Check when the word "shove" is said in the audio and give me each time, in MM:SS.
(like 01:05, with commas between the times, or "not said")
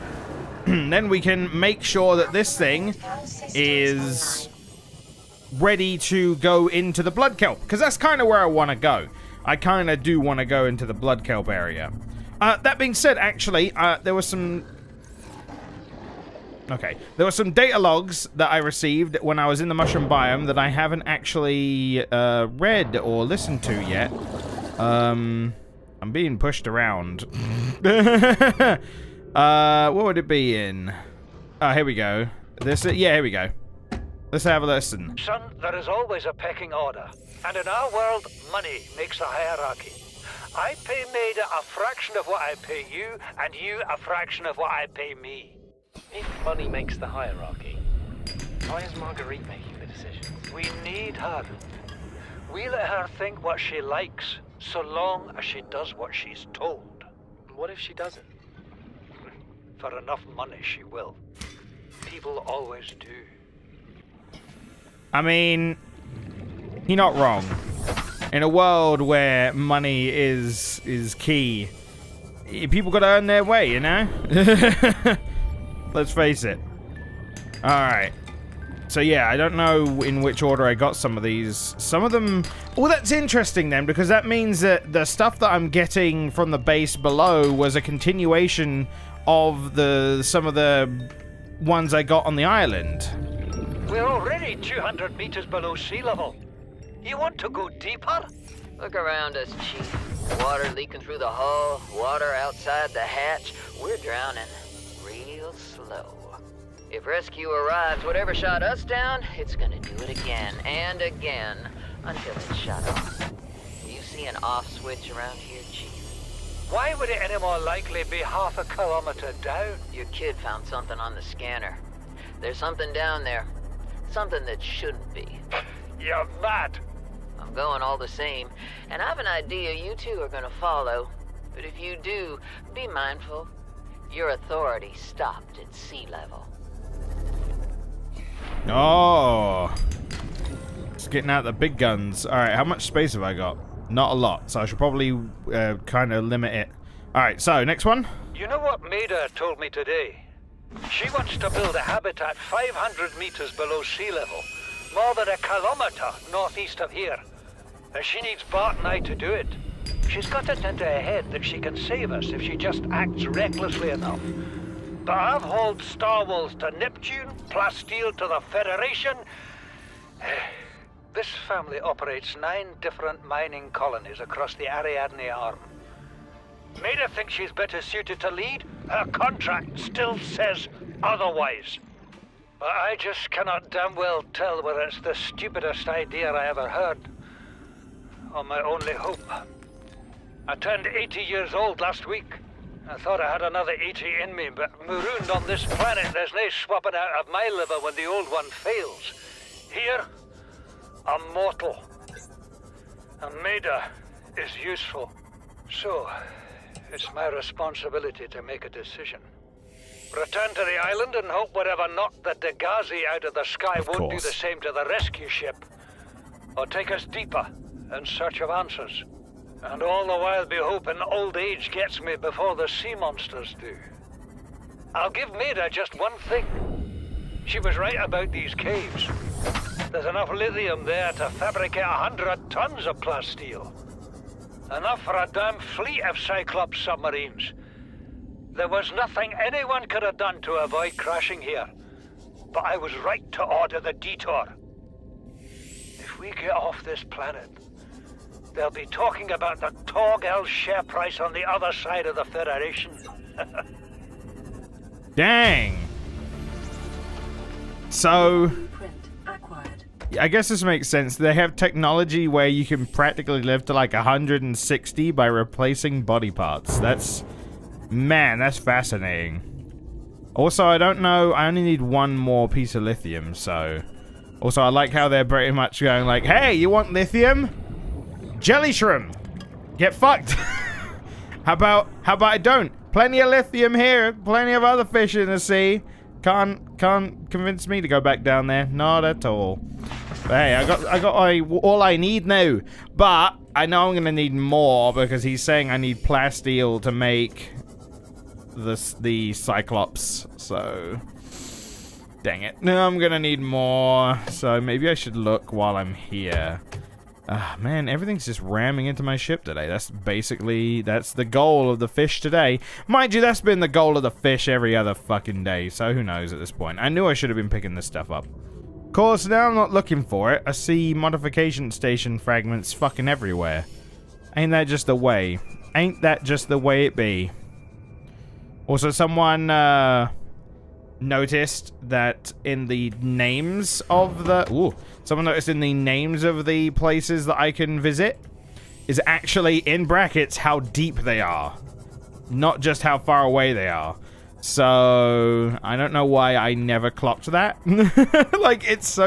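not said.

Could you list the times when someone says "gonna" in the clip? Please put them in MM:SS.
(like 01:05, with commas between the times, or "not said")
01:49, 02:10, 04:53, 05:02.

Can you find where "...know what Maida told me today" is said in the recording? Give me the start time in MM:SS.
02:28.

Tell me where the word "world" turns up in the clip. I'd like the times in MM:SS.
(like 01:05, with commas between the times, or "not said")
00:37, 01:08.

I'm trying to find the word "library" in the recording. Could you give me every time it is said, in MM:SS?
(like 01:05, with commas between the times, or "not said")
not said.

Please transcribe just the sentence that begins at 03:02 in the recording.
But I just cannot damn well tell whether it's the stupidest idea I ever heard, or my only hope.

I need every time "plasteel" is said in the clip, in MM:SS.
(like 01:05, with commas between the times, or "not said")
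02:47, 03:52, 04:55.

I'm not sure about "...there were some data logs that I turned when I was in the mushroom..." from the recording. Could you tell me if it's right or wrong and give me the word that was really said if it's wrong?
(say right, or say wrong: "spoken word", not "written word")
wrong: "received", not "turned".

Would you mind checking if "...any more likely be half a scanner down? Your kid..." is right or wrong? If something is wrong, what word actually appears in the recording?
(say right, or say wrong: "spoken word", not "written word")
wrong: "kilometer", not "scanner".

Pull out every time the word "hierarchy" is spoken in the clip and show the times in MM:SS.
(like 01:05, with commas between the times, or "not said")
00:39, 00:47.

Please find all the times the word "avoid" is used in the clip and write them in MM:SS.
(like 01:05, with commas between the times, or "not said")
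04:00.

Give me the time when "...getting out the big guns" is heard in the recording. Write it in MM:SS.
02:21.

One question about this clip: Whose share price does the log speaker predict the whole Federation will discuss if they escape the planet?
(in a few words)
Torgal.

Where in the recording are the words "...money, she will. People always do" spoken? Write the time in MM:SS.
01:00.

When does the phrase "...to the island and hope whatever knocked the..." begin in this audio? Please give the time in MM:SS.
03:30.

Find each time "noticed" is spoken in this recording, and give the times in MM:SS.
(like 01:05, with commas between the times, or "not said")
05:30, 05:35.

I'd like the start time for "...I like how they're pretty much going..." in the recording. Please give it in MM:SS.
04:34.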